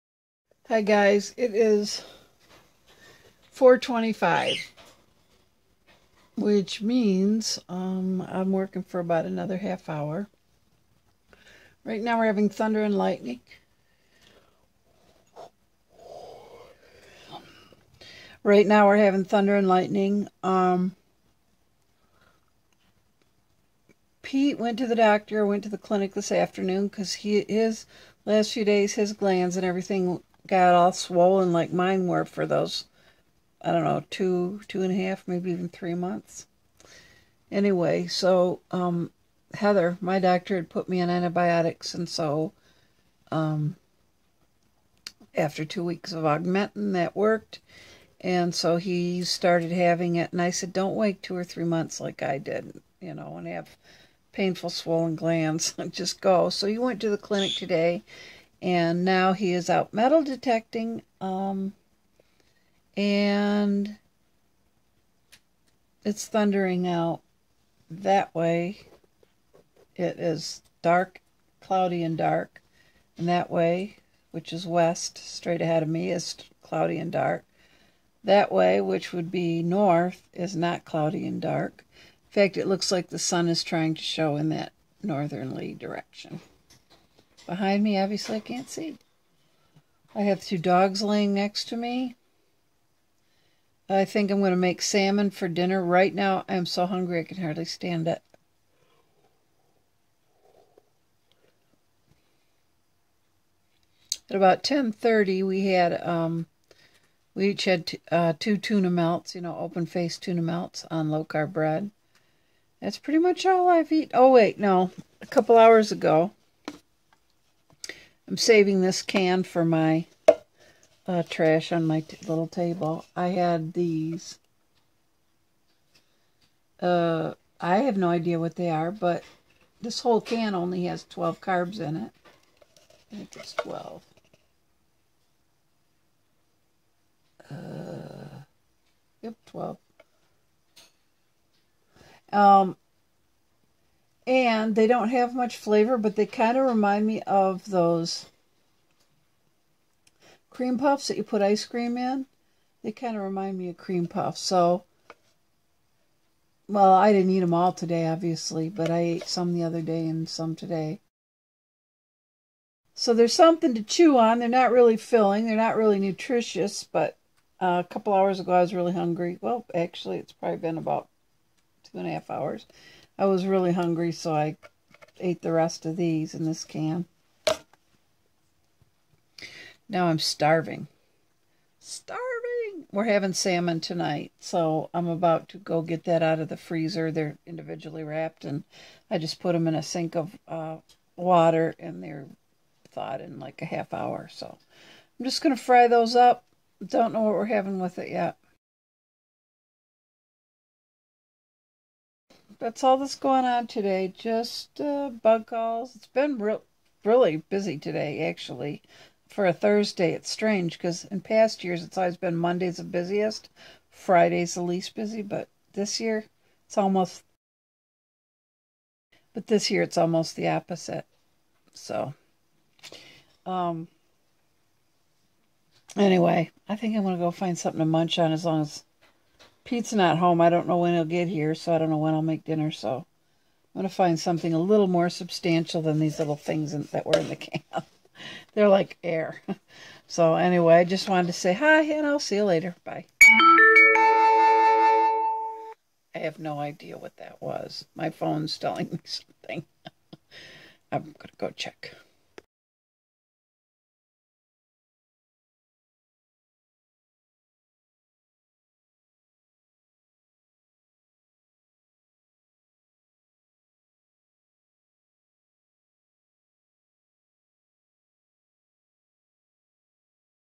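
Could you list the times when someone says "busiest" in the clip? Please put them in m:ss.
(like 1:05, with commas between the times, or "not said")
3:32.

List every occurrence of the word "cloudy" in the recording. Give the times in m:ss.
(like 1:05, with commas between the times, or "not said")
1:11, 1:16, 1:20.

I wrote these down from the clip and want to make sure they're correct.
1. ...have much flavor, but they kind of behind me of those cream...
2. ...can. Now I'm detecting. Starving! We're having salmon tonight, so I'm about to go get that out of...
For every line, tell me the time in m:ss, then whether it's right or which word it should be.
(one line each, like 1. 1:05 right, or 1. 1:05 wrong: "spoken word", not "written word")
1. 2:25 wrong: "remind", not "behind"
2. 2:56 wrong: "starving", not "detecting".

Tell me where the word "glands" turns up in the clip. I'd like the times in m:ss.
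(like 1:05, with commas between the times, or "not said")
0:29, 0:55.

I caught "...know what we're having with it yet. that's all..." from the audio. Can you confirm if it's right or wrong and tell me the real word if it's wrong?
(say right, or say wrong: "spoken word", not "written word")
right.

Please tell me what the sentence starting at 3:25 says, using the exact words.
It's been real, really busy today, actually.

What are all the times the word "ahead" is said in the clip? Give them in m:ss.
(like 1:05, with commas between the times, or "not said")
1:15.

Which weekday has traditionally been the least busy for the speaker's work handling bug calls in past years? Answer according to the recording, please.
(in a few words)
Fridays.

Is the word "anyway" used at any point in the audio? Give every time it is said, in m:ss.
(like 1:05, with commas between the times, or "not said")
0:37, 3:45, 4:00.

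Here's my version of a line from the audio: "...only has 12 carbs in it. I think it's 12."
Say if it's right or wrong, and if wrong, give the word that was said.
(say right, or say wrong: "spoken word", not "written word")
right.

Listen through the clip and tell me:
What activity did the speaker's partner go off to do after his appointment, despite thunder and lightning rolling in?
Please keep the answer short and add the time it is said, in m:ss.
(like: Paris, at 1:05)
Metal detecting, at 0:59.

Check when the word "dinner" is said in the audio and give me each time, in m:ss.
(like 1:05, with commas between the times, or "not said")
1:35, 3:52.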